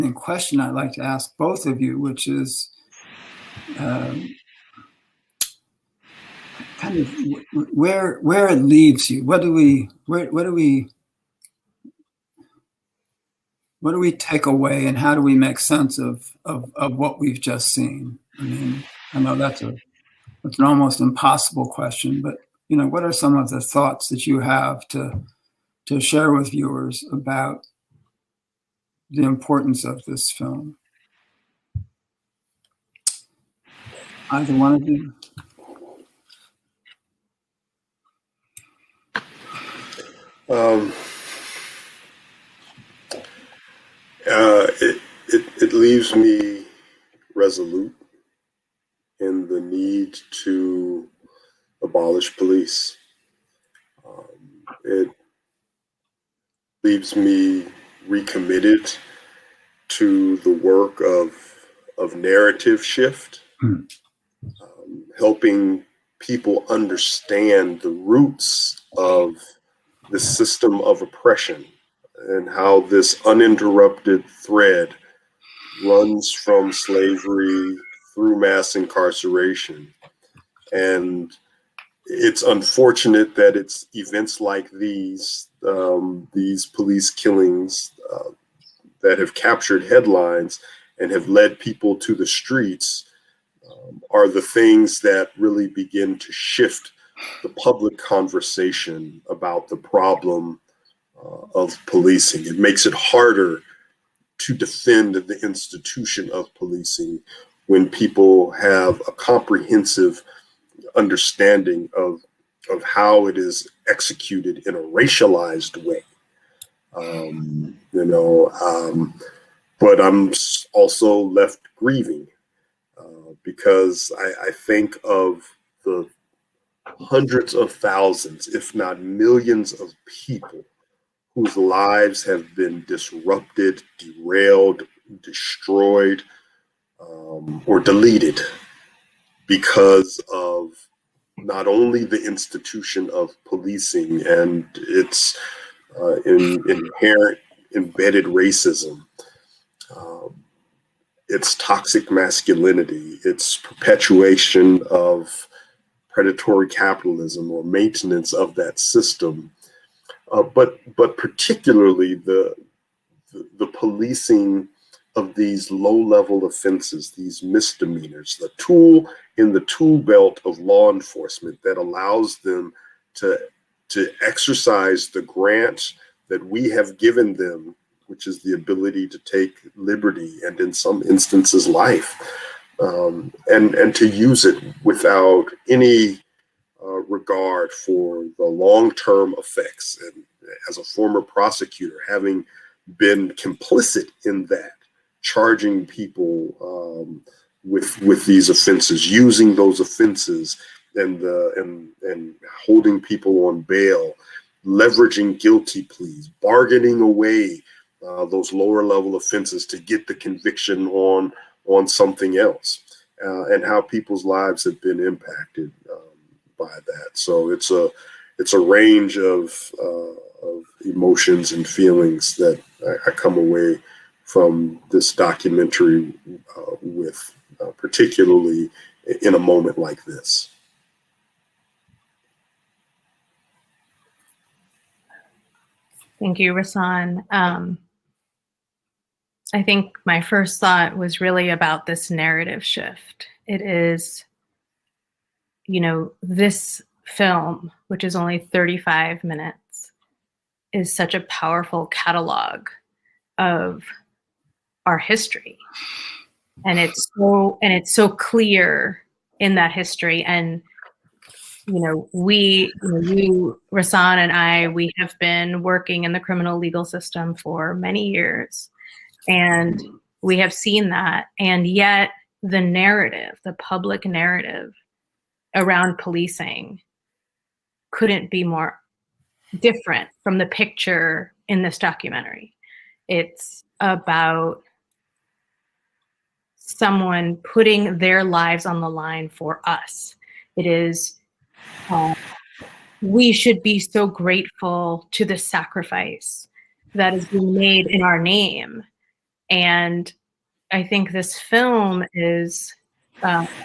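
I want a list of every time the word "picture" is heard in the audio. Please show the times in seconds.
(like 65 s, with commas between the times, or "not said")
280 s.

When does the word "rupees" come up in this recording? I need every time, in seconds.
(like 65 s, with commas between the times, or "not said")
not said.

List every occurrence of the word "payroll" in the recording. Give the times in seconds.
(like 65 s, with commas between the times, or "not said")
not said.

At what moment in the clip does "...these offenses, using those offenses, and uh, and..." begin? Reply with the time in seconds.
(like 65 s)
198 s.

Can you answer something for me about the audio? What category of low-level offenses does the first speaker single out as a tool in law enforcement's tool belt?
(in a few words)
misdemeanors.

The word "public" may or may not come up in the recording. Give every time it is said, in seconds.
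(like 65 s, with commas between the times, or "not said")
97 s, 273 s.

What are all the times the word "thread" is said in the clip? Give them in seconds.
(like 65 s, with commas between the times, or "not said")
74 s.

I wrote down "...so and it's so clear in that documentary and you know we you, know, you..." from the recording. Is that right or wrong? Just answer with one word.
wrong.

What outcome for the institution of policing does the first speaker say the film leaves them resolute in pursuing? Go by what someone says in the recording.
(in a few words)
abolish police.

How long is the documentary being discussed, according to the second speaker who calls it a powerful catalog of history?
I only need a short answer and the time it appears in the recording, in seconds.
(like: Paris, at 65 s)
35 minutes, at 248 s.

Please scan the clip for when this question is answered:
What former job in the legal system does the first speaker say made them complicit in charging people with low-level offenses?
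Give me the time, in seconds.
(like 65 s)
191 s.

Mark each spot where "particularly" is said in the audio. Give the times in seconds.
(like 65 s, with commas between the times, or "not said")
161 s, 227 s.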